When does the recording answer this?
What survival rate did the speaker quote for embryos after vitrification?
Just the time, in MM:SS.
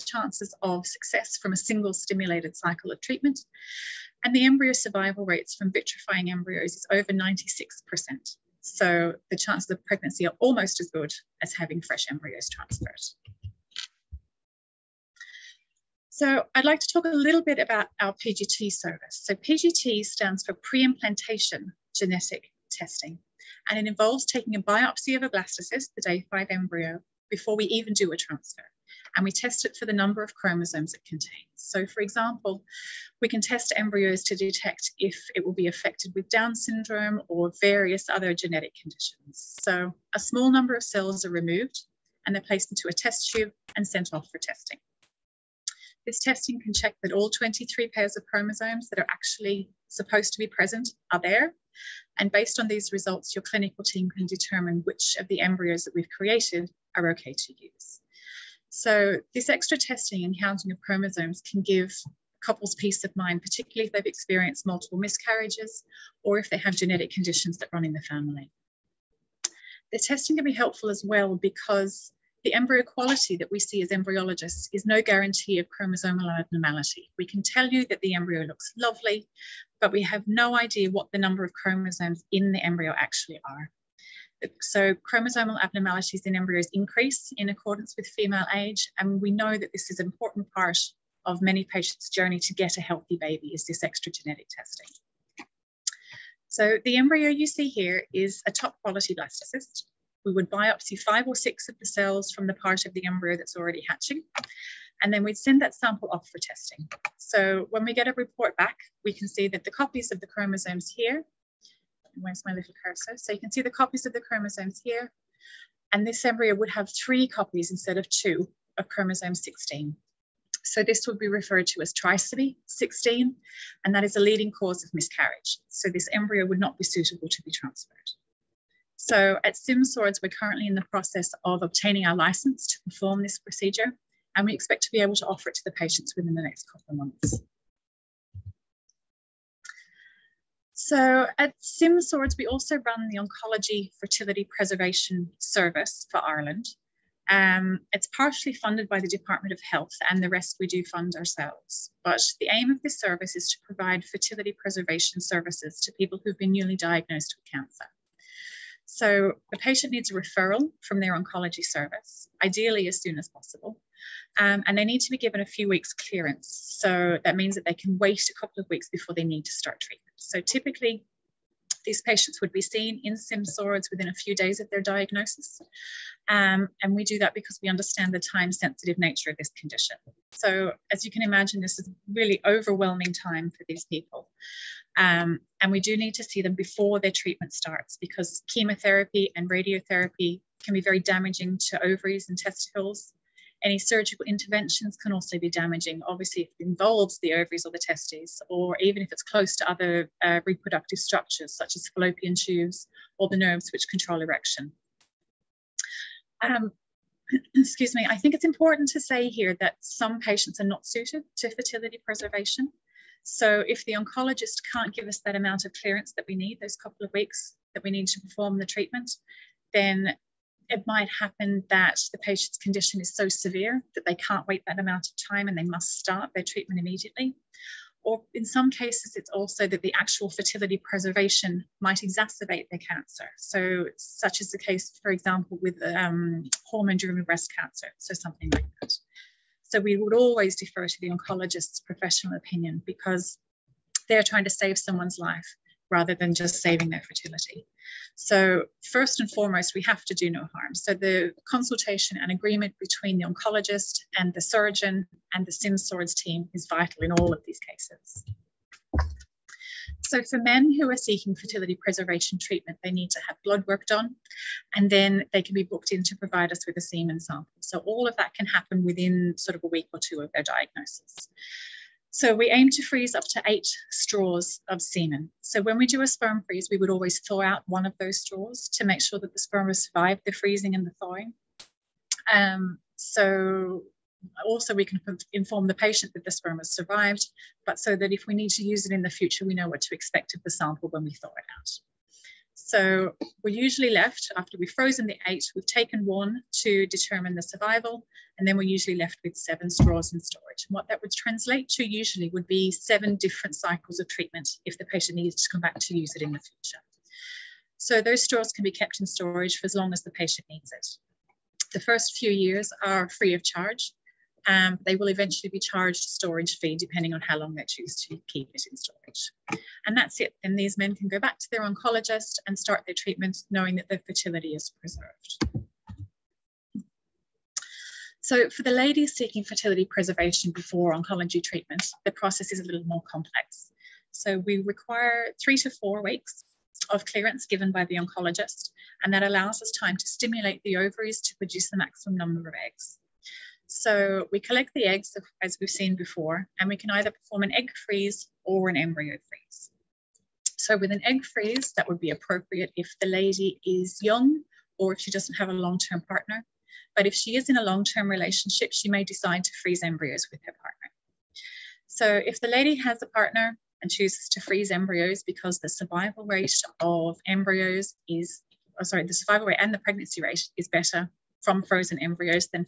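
00:06.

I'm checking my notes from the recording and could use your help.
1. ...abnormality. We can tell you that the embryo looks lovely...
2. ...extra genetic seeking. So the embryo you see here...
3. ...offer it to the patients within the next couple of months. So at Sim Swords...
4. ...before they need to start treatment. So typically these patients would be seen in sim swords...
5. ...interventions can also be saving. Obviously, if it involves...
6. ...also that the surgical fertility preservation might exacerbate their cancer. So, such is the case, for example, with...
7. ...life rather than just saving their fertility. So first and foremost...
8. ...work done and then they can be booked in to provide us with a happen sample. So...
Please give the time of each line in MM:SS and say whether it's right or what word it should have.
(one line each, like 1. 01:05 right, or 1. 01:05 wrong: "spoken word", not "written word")
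1. 01:16 right
2. 01:33 wrong: "testing", not "seeking"
3. 02:15 right
4. 02:48 right
5. 03:14 wrong: "damaging", not "saving"
6. 03:49 wrong: "actual", not "surgical"
7. 04:05 right
8. 04:23 wrong: "semen", not "happen".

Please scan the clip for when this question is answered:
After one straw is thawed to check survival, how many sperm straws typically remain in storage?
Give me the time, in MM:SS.
04:59.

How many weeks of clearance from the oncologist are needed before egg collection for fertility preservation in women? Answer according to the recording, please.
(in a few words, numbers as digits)
3 to 4 weeks.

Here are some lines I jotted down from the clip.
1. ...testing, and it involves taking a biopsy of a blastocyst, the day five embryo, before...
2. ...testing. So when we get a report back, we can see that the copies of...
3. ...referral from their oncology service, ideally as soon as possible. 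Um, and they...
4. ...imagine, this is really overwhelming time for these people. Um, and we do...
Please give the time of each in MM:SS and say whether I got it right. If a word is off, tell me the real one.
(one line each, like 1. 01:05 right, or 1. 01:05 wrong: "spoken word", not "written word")
1. 00:22 right
2. 01:46 right
3. 02:40 right
4. 03:01 right.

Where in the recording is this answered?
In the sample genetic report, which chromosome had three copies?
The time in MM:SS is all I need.
01:58.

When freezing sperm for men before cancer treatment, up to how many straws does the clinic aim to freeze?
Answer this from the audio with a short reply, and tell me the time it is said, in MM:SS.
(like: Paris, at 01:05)
8, at 04:33.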